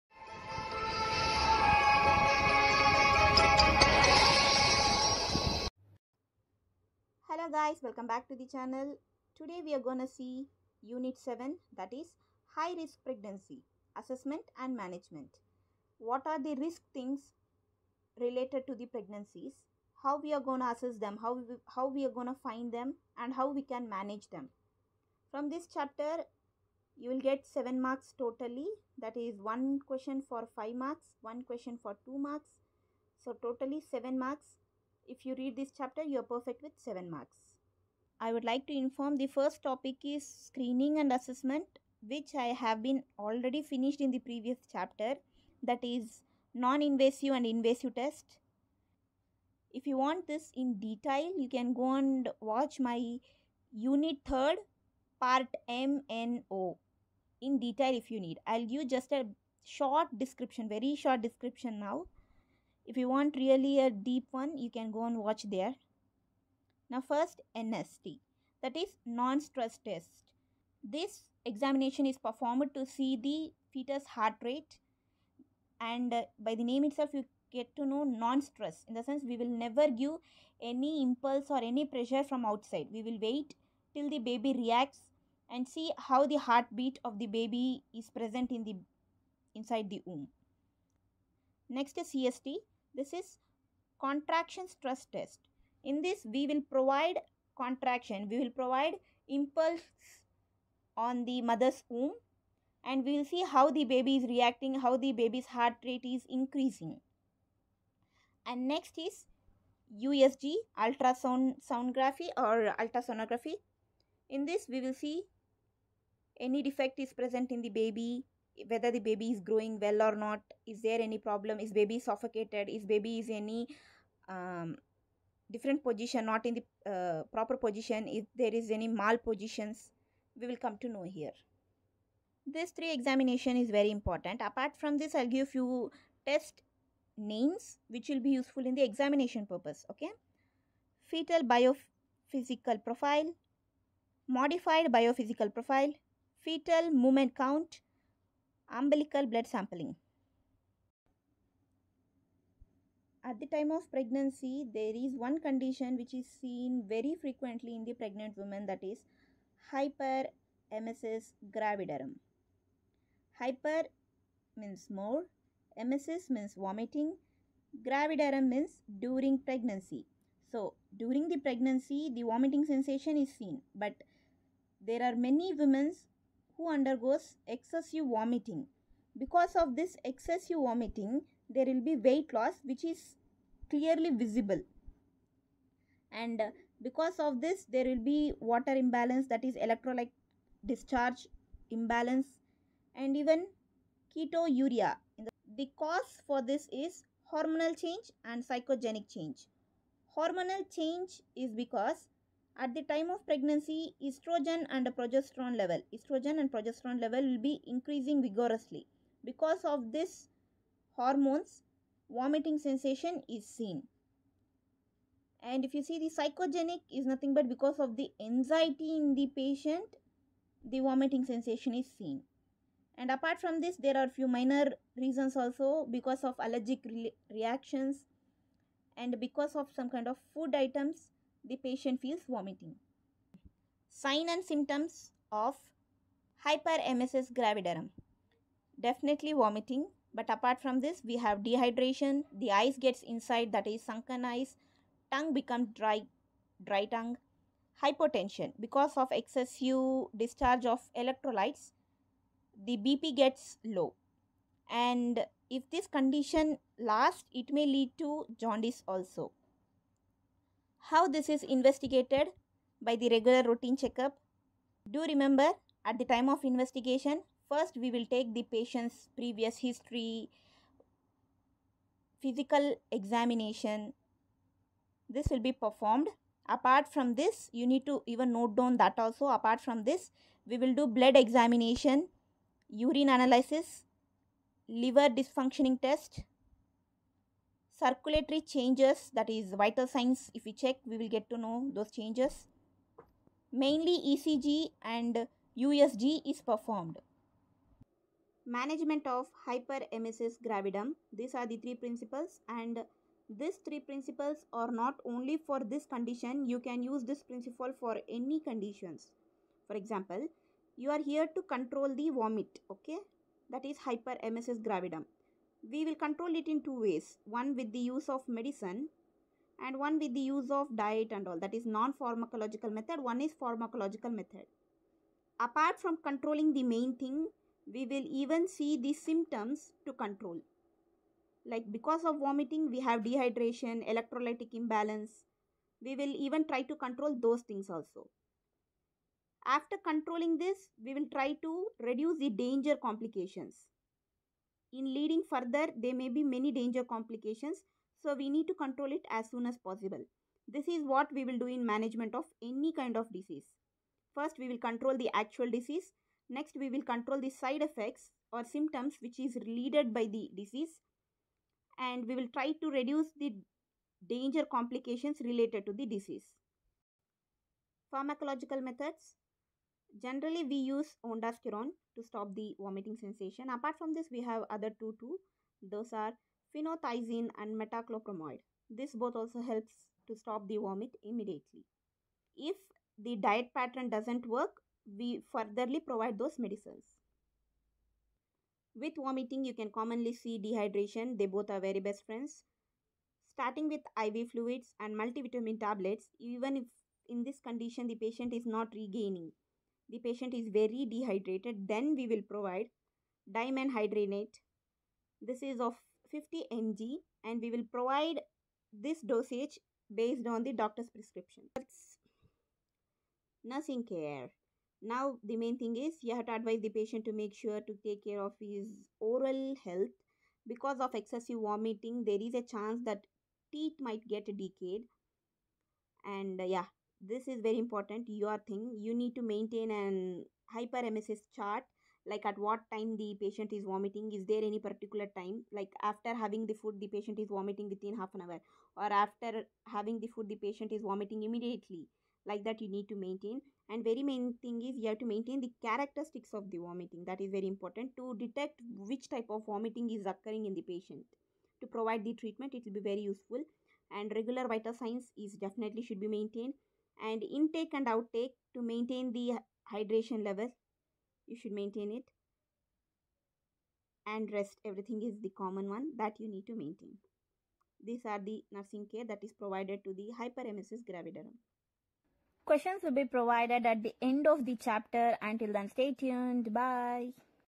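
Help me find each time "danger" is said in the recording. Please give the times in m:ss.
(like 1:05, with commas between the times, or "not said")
5:42, 5:46, 6:04.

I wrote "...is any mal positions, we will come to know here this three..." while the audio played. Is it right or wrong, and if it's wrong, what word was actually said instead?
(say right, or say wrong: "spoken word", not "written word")
right.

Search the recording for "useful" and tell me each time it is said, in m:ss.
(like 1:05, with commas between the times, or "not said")
2:18, 7:33.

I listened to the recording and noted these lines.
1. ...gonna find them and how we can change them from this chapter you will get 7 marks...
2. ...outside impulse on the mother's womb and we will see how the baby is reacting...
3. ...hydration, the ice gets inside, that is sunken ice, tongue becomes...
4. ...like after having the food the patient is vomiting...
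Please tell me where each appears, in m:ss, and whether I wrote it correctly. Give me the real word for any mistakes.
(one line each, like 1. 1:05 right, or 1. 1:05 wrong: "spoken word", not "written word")
1. 0:22 wrong: "manage", not "change"
2. 1:38 wrong: "provide", not "outside"
3. 4:01 wrong: "dehydration", not "hydration"
4. 7:15 right.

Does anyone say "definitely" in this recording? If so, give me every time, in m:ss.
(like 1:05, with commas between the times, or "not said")
3:58, 7:35.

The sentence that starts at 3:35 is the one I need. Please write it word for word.
And if you see the psychogenic is nothing but because of the anxiety in the patient, the vomiting sensation is seen.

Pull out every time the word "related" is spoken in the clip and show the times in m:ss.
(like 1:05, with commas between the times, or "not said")
0:18, 5:59, 6:05.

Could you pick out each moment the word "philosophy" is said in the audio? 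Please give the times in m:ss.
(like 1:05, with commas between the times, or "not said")
not said.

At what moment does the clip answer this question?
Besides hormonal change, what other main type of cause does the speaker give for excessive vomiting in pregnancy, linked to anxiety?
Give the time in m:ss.
3:18.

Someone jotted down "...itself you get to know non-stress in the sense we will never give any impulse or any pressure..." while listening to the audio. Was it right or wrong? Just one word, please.
right.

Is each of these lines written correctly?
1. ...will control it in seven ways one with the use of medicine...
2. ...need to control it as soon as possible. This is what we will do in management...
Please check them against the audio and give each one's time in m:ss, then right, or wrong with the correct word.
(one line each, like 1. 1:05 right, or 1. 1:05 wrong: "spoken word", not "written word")
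1. 5:15 wrong: "two", not "seven"
2. 5:48 right.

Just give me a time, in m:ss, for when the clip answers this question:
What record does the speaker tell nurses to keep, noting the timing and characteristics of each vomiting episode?
7:10.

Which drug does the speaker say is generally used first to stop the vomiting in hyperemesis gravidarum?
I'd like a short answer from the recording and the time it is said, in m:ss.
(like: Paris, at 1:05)
Ondansetron, at 6:11.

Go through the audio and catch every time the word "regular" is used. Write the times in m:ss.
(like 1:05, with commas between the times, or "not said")
4:23, 7:34.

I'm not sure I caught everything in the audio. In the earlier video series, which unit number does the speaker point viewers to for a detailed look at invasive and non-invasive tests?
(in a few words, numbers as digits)
Unit 3.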